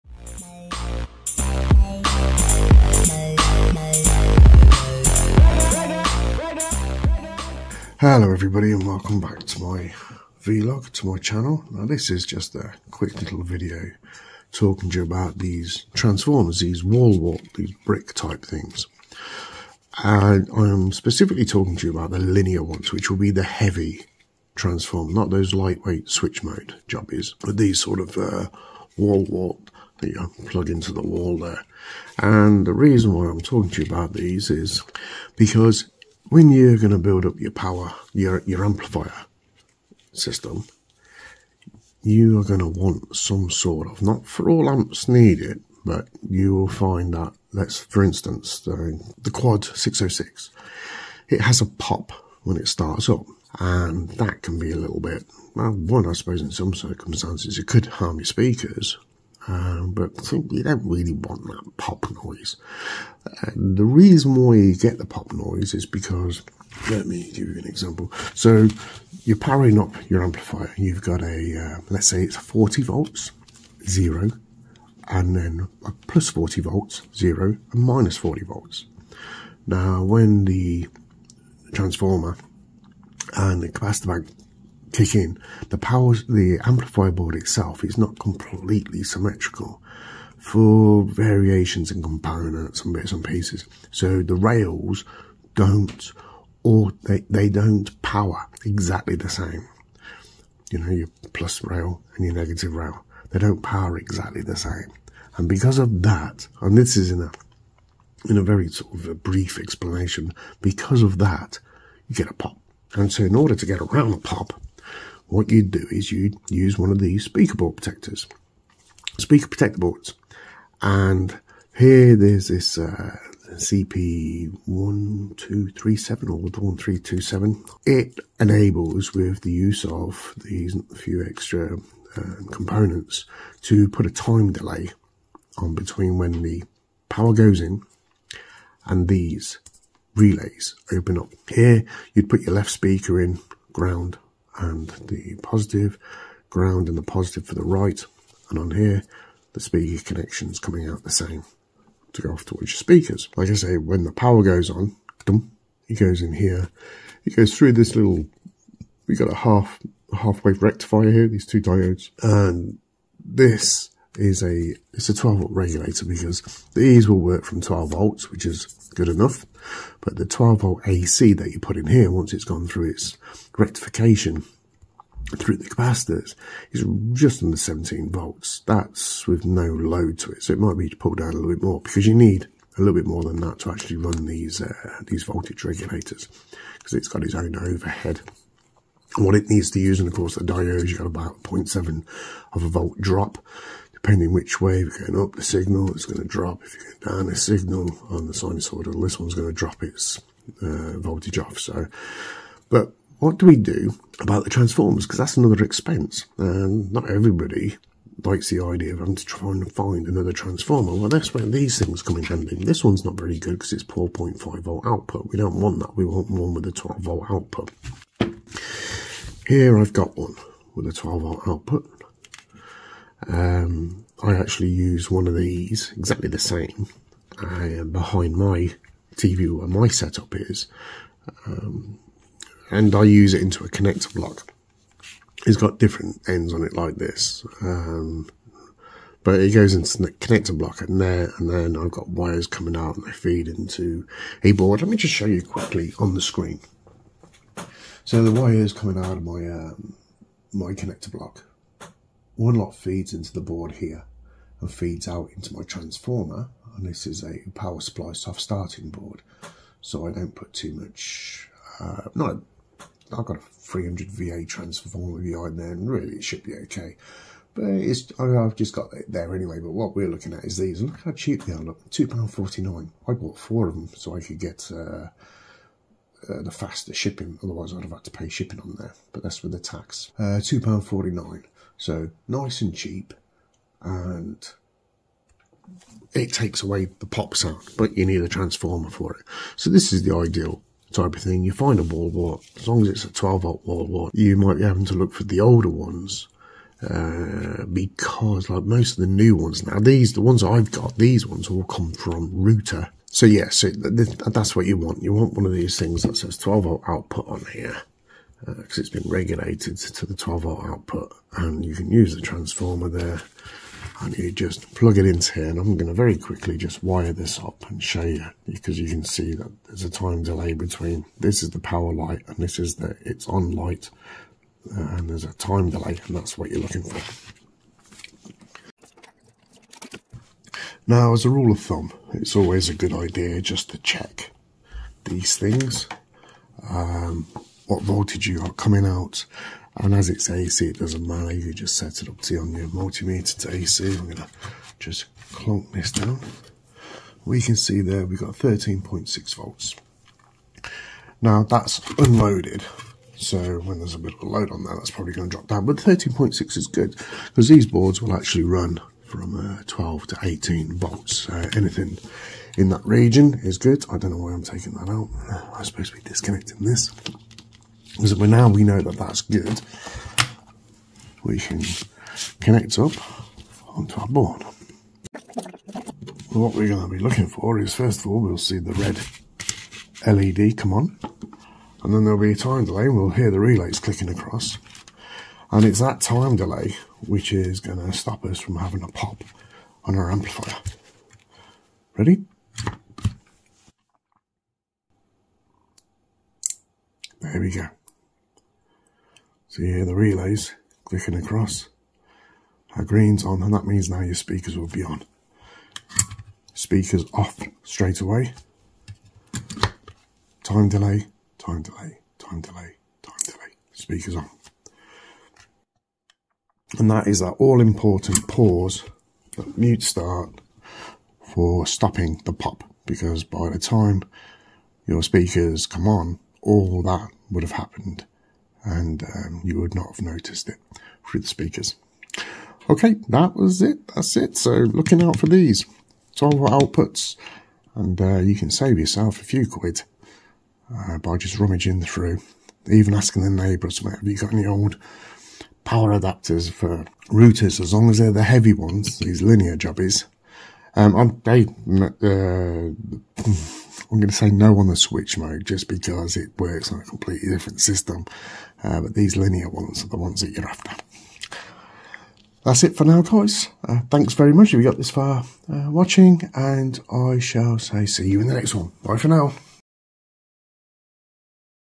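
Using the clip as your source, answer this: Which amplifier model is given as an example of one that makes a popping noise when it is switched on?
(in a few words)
Quad 606.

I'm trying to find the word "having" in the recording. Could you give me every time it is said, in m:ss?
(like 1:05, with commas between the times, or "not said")
3:28, 4:54, 6:28.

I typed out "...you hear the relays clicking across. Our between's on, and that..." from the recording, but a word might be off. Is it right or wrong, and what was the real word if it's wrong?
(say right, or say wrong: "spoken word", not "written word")
wrong: "green", not "between".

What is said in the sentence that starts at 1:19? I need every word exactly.
Now, when the transformer and the capacitor bank kick in, the power.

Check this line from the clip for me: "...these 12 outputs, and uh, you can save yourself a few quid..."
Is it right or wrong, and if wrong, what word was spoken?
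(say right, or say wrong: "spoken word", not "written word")
right.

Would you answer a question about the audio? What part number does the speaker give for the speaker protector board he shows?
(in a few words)
CP1237.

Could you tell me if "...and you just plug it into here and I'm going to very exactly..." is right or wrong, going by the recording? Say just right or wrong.
wrong.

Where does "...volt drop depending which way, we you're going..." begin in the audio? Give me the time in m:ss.
3:12.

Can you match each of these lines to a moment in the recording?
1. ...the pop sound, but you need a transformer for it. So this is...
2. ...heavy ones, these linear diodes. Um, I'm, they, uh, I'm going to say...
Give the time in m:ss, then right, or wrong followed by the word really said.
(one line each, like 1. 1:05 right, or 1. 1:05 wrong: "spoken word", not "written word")
1. 4:46 right
2. 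7:28 wrong: "jobbies", not "diodes".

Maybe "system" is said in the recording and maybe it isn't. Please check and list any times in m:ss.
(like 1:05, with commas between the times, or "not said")
0:40, 7:37.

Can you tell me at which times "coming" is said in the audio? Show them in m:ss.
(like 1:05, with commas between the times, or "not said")
2:30, 4:02, 4:08, 5:38.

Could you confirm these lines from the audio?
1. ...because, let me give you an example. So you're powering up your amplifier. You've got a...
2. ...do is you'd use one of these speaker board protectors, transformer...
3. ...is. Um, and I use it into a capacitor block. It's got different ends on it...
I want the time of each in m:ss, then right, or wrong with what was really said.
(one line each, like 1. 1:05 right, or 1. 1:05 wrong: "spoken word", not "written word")
1. 1:05 right
2. 1:55 wrong: "speaker", not "transformer"
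3. 3:50 wrong: "connector", not "capacitor".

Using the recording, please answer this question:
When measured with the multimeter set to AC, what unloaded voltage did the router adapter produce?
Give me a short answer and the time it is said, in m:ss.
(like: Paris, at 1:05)
13.6 volts, at 5:48.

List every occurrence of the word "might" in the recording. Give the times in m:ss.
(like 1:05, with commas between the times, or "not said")
3:00, 4:54.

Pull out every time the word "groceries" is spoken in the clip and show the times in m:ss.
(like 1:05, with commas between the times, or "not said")
not said.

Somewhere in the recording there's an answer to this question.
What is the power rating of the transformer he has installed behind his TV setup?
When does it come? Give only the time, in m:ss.
4:23.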